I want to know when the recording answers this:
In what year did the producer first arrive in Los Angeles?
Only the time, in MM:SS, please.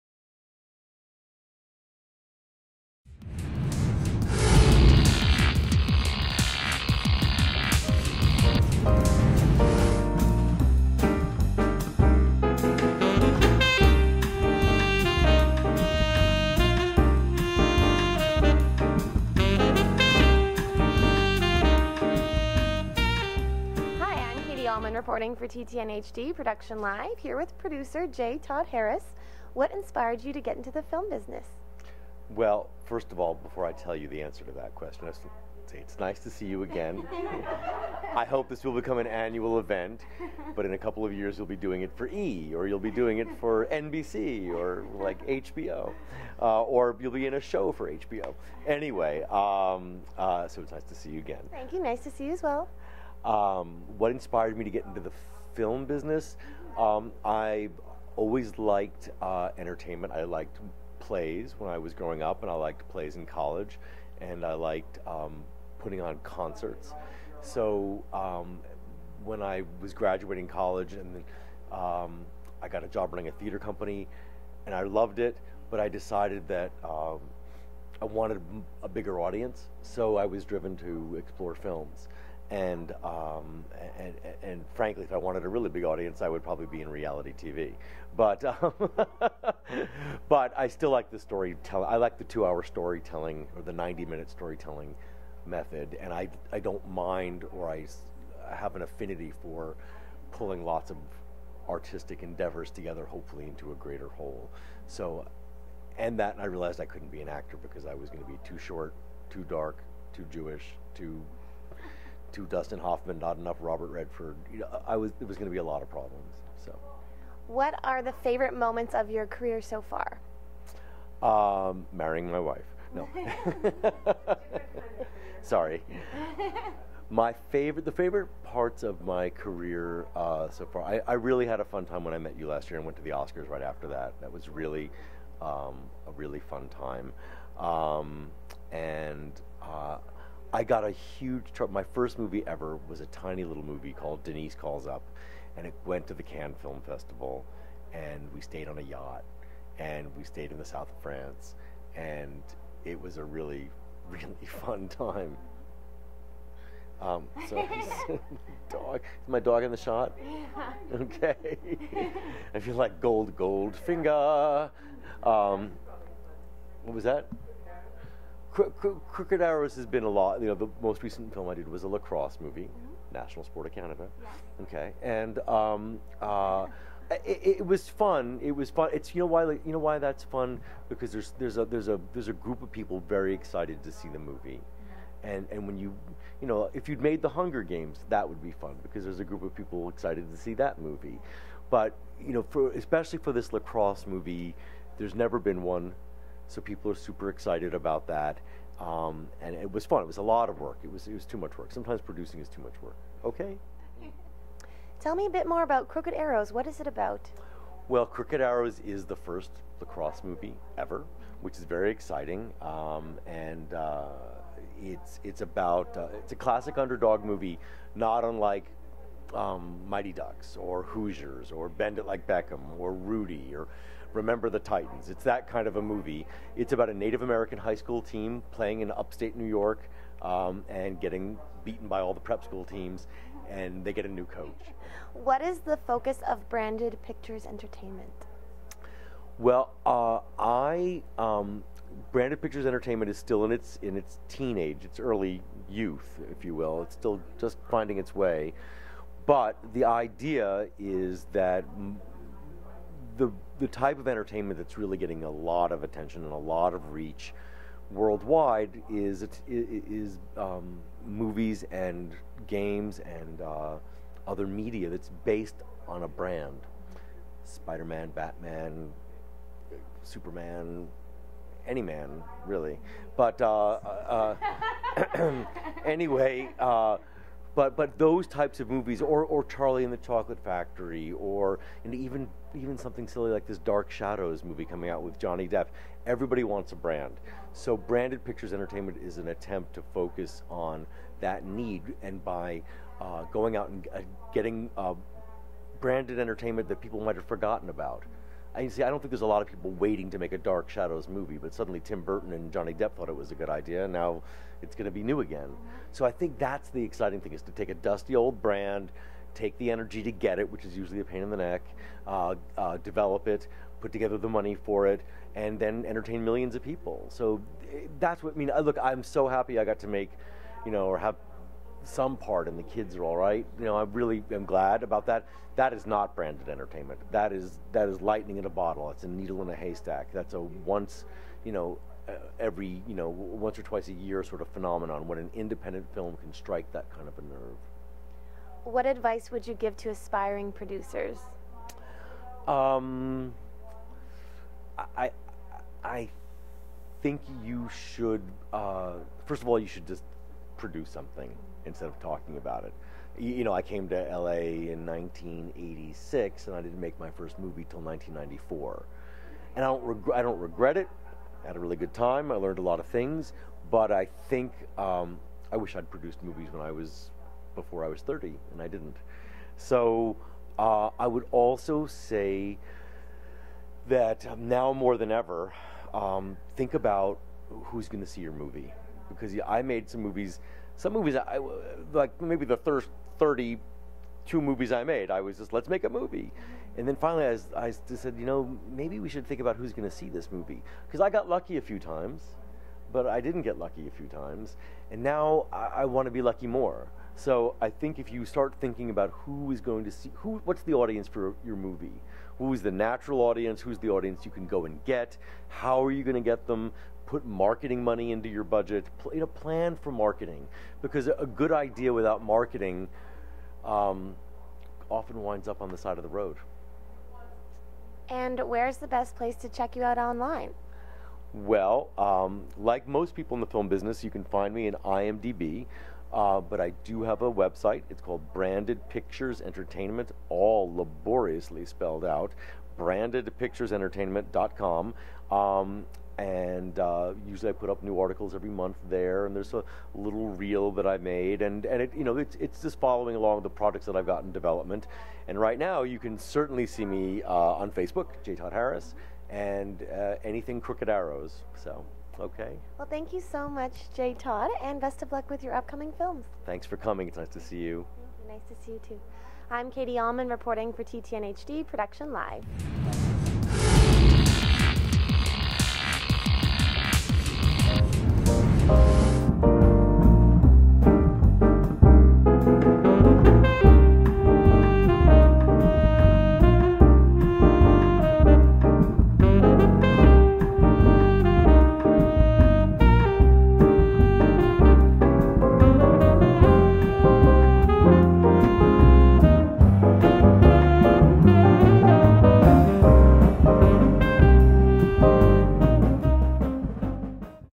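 05:54.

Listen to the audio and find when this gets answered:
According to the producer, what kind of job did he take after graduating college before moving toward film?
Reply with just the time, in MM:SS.
01:13.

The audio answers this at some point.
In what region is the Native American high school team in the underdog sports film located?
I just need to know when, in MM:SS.
03:48.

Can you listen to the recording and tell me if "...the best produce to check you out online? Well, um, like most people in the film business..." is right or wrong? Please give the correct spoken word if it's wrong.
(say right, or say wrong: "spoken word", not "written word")
wrong: "place", not "produce".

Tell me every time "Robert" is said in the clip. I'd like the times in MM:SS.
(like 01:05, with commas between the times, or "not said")
01:53.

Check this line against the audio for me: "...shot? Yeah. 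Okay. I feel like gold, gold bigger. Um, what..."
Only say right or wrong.
wrong.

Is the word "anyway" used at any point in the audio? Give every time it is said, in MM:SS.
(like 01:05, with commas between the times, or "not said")
00:48, 04:35.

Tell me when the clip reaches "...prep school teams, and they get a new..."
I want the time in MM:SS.
03:52.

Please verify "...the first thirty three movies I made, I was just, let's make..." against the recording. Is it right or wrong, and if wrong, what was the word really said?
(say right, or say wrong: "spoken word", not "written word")
wrong: "two", not "three".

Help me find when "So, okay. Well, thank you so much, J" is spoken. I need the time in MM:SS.
07:31.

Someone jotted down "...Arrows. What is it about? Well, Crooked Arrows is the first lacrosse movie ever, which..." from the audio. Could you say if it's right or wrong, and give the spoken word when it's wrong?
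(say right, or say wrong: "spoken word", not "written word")
right.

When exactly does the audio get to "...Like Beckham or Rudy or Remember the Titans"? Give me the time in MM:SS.
03:42.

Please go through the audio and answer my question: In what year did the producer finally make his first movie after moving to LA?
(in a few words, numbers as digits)
1994.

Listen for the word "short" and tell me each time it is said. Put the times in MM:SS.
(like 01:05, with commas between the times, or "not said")
01:48.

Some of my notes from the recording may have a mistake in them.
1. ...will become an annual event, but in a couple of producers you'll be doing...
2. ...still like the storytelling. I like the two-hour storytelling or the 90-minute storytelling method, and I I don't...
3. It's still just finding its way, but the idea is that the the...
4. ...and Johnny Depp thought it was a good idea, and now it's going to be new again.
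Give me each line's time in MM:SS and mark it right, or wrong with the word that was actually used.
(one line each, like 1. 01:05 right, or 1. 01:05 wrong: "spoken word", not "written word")
1. 00:38 wrong: "years", not "producers"
2. 01:30 right
3. 04:06 right
4. 05:02 right.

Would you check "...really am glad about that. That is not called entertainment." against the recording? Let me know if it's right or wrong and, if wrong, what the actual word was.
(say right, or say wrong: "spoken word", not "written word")
wrong: "branded", not "called".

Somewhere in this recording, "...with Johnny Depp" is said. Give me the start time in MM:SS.
04:45.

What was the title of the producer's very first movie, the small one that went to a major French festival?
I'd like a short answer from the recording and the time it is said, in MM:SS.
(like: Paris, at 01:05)
Denise Calls Up, at 02:24.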